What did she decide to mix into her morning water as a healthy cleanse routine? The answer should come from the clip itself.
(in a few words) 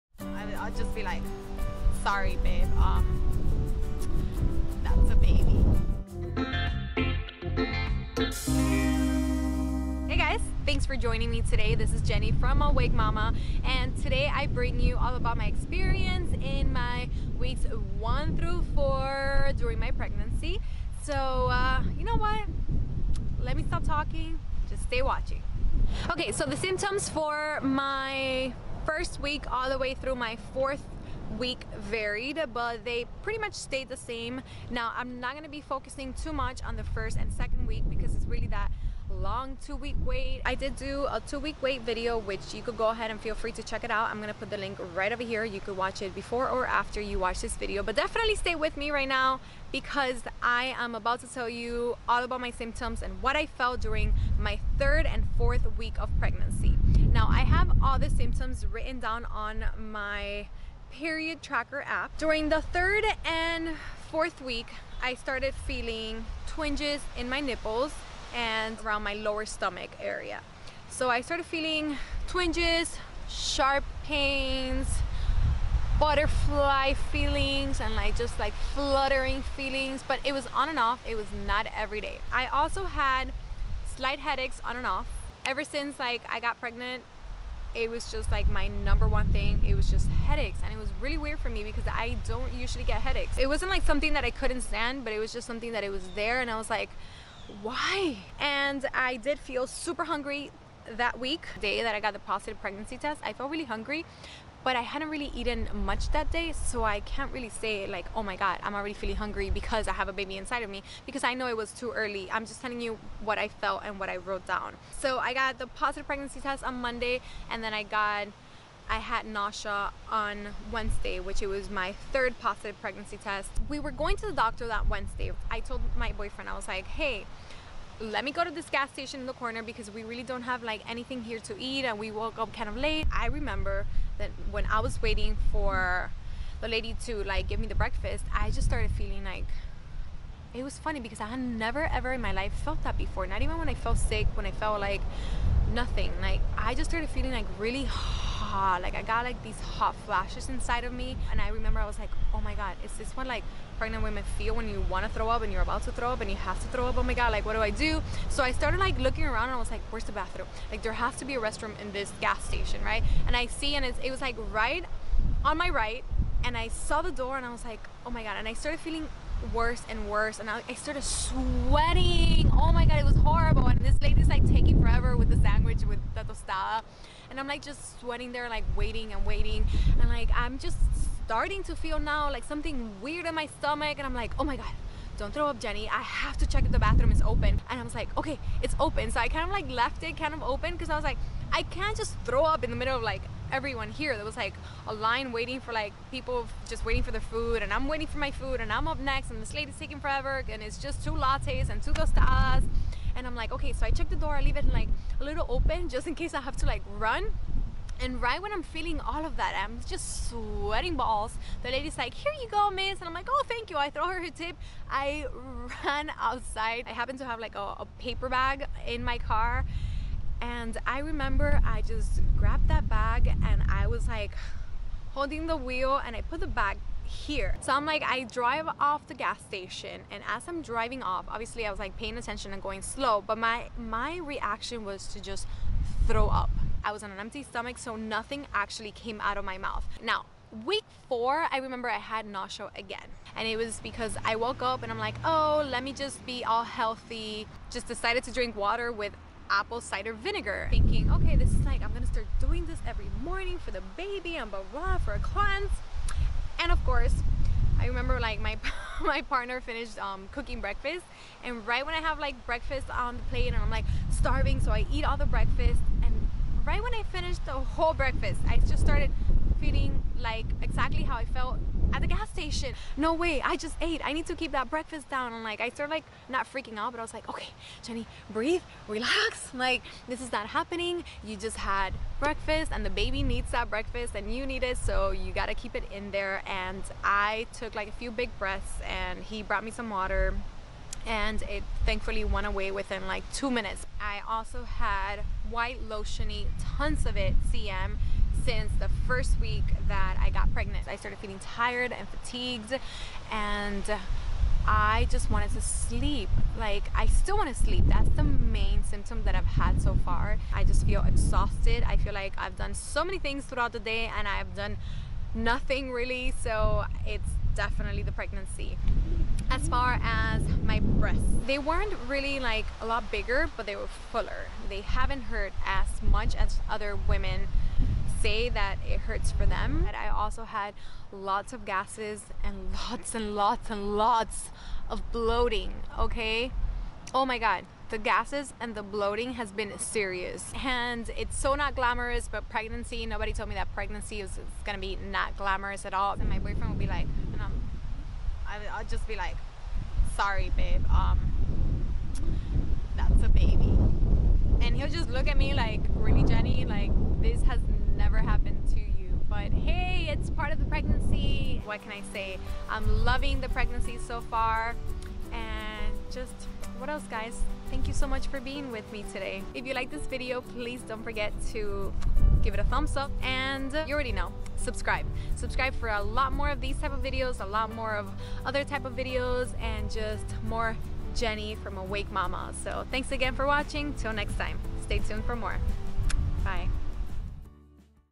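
apple cider vinegar.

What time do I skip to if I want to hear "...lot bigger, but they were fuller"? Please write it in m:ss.
5:22.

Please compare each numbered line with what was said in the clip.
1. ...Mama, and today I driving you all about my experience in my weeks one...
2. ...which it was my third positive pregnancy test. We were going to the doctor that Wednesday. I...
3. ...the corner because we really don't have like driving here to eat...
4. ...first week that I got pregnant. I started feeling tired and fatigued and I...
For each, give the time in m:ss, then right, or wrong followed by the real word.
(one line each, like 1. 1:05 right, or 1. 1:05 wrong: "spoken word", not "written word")
1. 0:12 wrong: "bring", not "driving"
2. 2:01 right
3. 2:09 wrong: "anything", not "driving"
4. 4:59 right.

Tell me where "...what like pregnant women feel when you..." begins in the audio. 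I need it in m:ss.
2:33.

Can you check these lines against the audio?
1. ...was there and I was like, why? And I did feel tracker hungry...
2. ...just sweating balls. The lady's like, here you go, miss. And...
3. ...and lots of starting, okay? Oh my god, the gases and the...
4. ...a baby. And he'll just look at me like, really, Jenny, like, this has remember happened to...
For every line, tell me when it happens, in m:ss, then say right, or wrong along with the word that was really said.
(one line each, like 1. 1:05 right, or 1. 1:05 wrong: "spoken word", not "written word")
1. 1:35 wrong: "super", not "tracker"
2. 3:29 right
3. 5:33 wrong: "bloating", not "starting"
4. 5:53 wrong: "never", not "remember".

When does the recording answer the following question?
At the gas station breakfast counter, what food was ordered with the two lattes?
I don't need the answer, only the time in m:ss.
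3:21.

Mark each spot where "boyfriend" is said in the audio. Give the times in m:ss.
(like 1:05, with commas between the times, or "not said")
2:06, 5:46.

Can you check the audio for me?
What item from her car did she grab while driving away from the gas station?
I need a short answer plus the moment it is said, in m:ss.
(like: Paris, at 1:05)
a paper bag, at 3:37.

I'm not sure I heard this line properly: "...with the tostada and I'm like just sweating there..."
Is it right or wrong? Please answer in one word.
right.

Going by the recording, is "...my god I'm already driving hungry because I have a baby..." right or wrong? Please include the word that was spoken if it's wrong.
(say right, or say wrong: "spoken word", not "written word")
wrong: "feeling", not "driving".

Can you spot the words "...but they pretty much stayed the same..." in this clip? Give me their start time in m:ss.
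0:32.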